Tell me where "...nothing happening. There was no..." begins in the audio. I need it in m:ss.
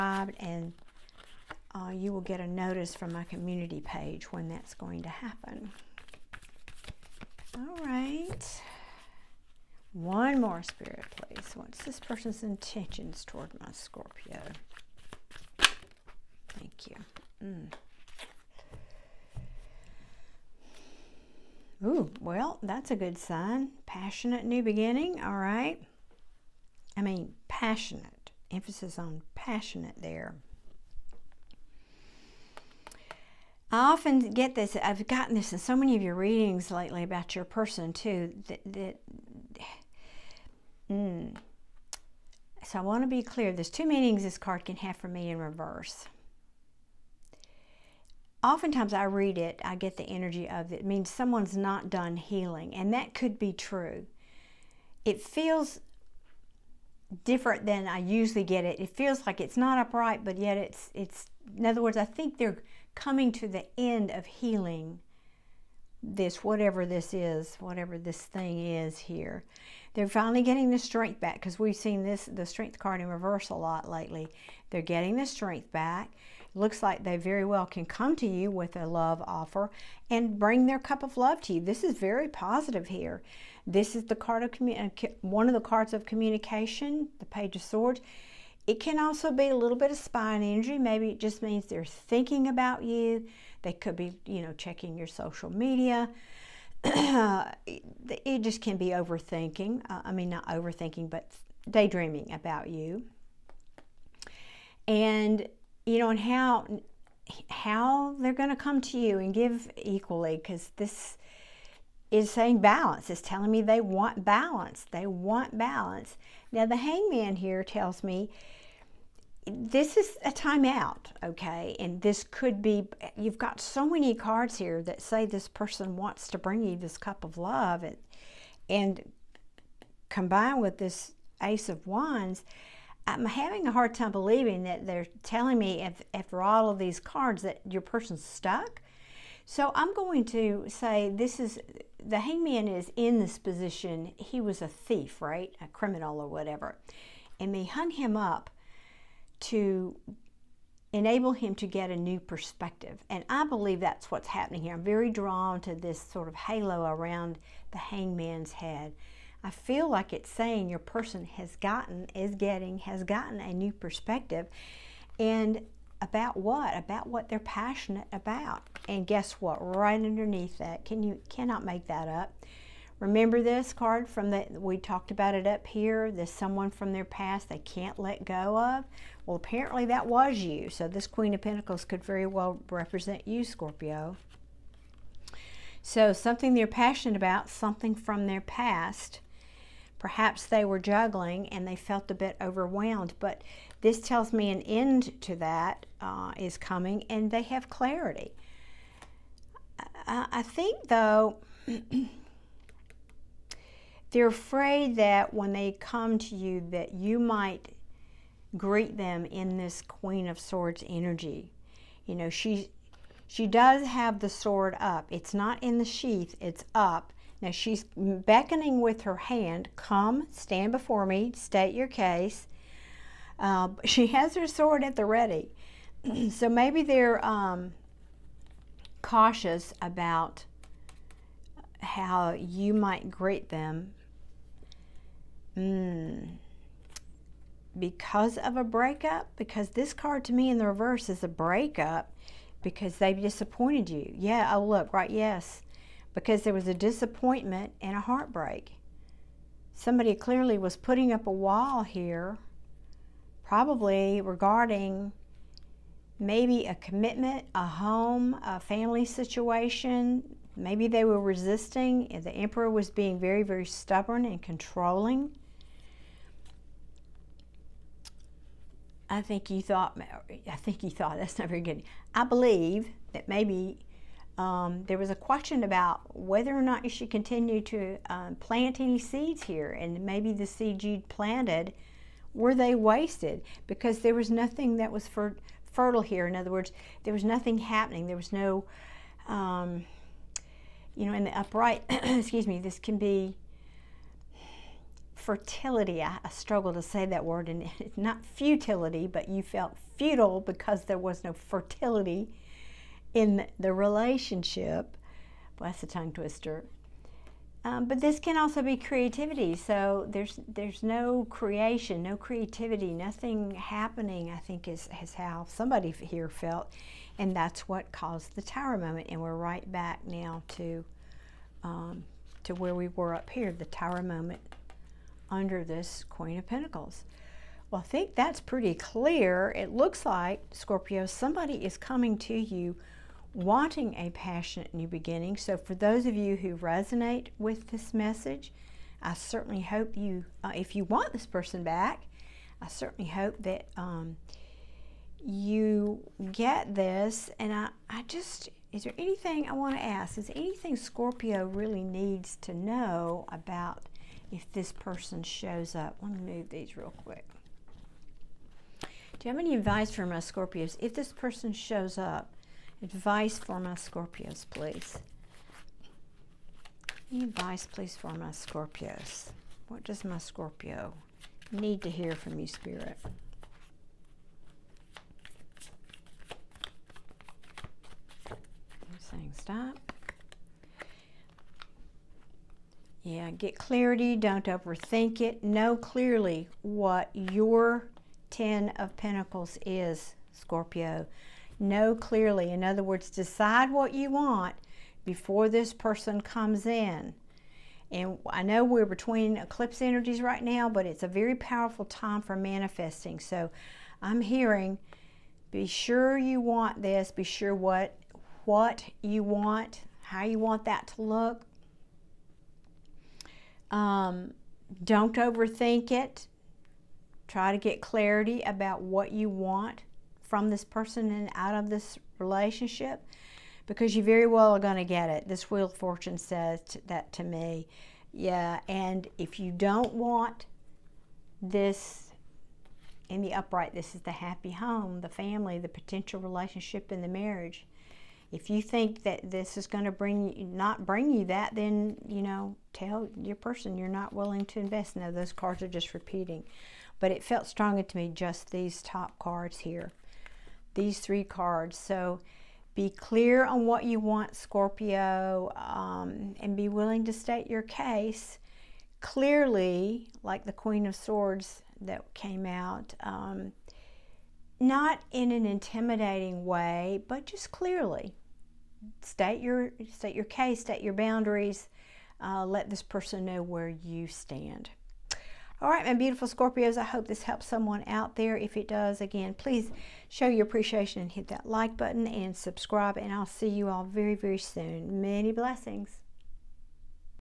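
4:47.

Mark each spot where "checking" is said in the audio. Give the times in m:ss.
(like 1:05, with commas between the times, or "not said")
1:34.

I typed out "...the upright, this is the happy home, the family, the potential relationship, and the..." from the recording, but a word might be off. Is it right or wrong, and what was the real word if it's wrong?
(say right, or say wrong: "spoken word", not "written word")
right.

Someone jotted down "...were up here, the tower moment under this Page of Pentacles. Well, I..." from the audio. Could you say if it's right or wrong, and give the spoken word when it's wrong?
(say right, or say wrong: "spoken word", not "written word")
wrong: "Queen", not "Page".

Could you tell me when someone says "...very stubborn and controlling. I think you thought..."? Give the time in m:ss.
4:23.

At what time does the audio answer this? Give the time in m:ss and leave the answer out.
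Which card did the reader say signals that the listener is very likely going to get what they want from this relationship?
7:05.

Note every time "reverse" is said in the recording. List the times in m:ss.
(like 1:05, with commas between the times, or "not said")
0:45, 1:13, 4:00.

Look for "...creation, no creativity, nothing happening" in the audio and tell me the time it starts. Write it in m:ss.
5:11.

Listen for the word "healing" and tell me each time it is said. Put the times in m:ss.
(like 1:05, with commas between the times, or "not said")
0:52, 1:04.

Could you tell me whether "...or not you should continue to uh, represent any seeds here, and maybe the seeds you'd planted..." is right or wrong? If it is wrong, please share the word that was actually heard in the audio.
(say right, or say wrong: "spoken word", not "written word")
wrong: "plant", not "represent".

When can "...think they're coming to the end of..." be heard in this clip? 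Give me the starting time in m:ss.
1:02.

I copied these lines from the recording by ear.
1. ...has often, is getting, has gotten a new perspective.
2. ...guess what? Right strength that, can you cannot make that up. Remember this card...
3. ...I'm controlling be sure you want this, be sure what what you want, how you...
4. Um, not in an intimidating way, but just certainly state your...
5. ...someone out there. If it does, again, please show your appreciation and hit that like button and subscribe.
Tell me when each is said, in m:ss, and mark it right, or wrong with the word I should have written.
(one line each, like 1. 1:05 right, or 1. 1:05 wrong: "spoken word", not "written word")
1. 2:41 wrong: "gotten", not "often"
2. 2:49 wrong: "underneath", not "strength"
3. 6:44 wrong: "hearing", not "controlling"
4. 7:43 wrong: "clearly", not "certainly"
5. 7:57 right.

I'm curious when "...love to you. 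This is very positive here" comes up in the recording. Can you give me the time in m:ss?
1:21.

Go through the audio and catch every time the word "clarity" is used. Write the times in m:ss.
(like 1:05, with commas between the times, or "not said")
3:17, 6:23, 6:57.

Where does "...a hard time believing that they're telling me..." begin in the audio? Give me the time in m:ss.
2:13.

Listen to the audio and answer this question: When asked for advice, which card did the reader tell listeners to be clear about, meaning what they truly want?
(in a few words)
Ten of Pentacles.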